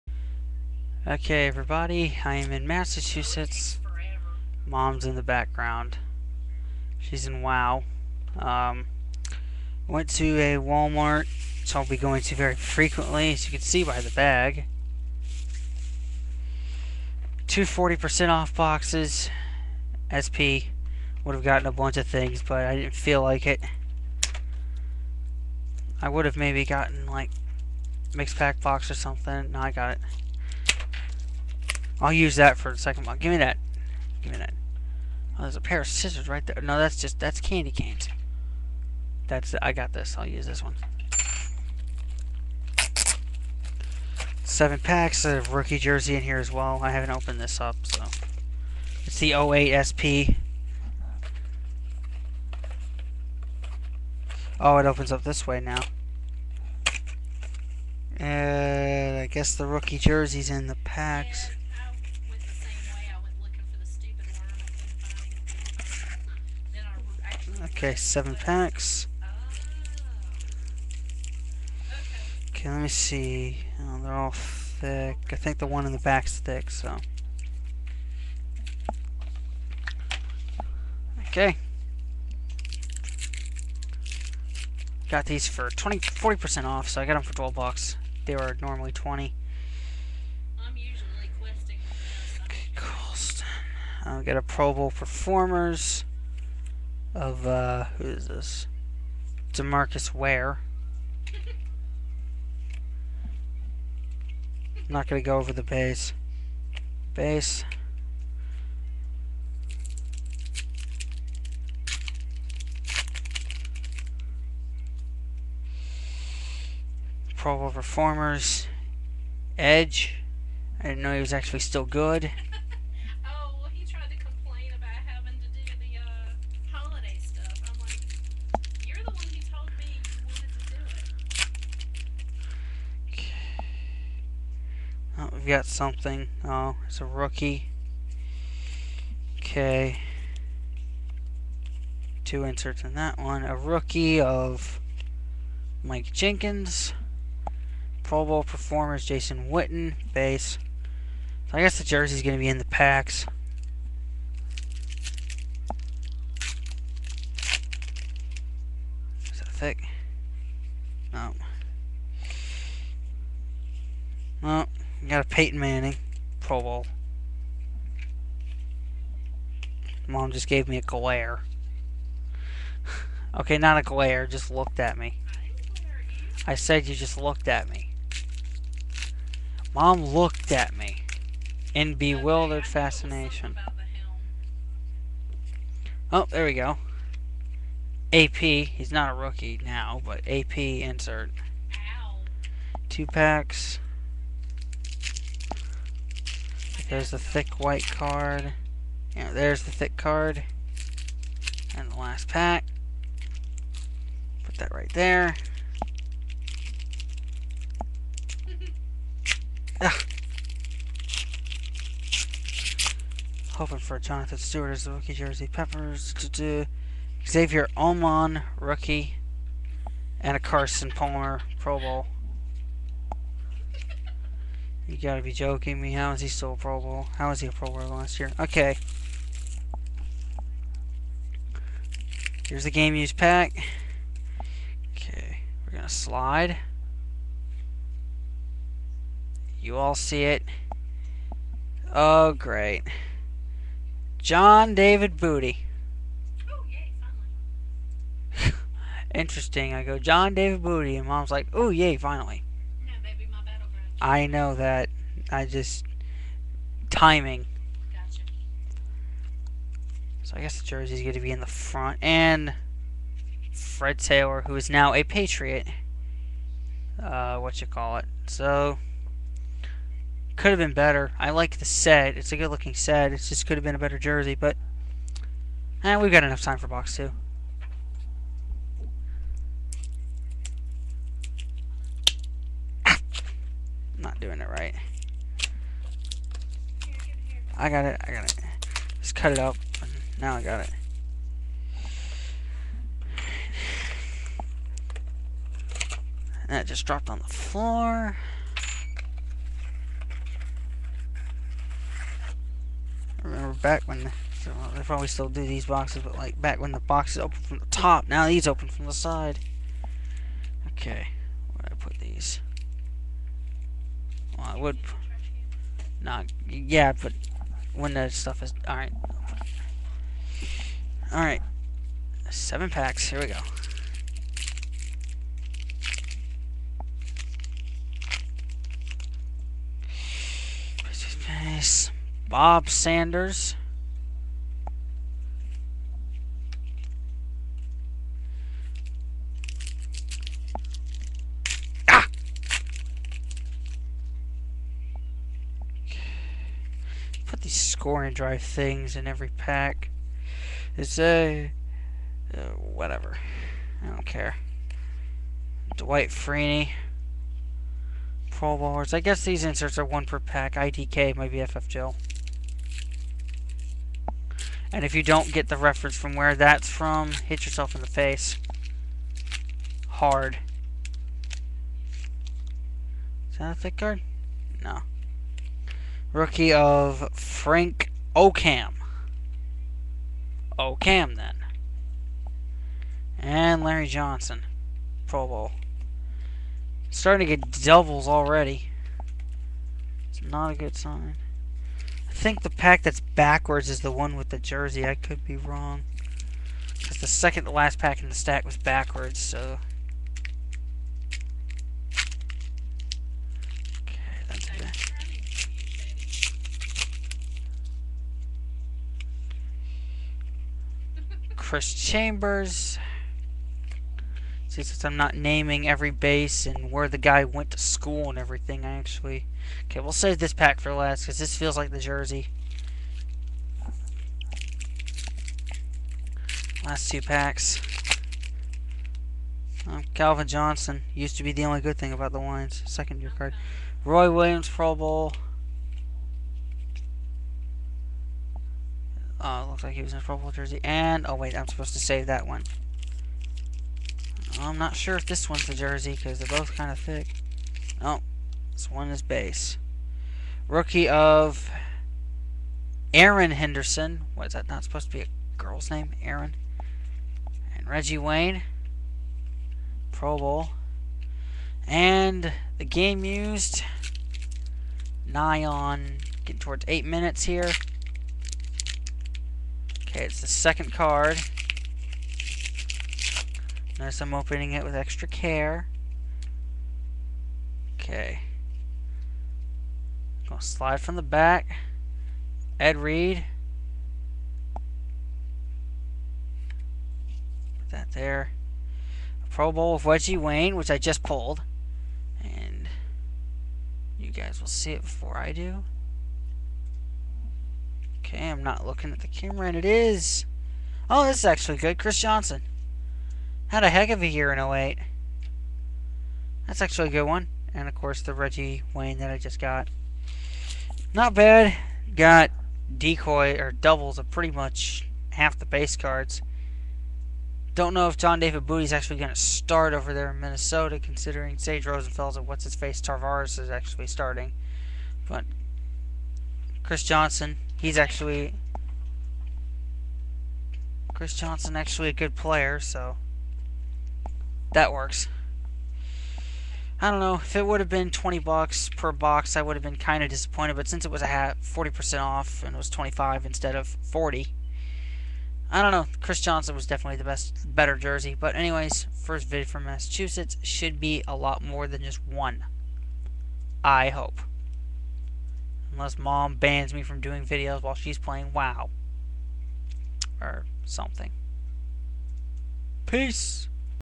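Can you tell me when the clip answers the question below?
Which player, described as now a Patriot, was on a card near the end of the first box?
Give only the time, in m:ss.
4:23.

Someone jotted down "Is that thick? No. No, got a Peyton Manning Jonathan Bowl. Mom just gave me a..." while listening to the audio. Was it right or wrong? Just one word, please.
wrong.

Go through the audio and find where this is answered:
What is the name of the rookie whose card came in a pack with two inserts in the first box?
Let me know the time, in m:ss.
2:25.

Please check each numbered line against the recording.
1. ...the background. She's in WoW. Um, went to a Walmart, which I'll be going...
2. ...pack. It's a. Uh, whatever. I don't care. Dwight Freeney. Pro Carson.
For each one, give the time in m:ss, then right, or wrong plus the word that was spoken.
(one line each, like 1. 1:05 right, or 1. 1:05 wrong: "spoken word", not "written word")
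1. 0:05 right
2. 5:49 wrong: "Bowlers", not "Carson".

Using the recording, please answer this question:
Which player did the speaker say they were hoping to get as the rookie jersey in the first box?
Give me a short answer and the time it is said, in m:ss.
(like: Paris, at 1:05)
Jonathan Stewart, at 3:33.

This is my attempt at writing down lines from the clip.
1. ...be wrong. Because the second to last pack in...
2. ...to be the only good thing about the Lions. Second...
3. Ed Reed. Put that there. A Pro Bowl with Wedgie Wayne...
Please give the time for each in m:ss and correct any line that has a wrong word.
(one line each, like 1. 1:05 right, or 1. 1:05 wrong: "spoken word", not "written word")
1. 6:35 right
2. 7:11 right
3. 8:02 right.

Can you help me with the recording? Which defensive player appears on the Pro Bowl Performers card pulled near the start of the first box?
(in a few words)
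Demarcus Ware.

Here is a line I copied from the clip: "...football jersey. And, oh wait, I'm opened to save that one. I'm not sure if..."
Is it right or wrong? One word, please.
wrong.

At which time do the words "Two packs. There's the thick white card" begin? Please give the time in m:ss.
3:12.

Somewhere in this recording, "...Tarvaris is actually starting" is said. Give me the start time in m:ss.
8:42.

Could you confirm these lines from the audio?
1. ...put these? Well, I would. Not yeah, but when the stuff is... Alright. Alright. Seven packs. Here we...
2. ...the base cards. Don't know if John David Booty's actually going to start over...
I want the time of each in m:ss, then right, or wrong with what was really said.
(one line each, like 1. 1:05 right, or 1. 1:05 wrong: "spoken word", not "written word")
1. 5:11 right
2. 8:35 right.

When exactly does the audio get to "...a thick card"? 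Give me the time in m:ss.
6:13.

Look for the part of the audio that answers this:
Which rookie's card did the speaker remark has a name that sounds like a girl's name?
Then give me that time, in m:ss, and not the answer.
7:32.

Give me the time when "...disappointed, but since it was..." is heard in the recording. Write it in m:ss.
9:00.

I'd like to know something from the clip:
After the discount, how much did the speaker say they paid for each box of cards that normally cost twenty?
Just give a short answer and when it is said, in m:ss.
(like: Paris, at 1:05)
12 bucks, at 1:27.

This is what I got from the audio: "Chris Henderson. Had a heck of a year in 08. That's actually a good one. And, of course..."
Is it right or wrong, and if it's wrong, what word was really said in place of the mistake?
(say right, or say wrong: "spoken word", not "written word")
wrong: "Johnson", not "Henderson".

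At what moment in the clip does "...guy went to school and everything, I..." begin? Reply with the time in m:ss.
6:56.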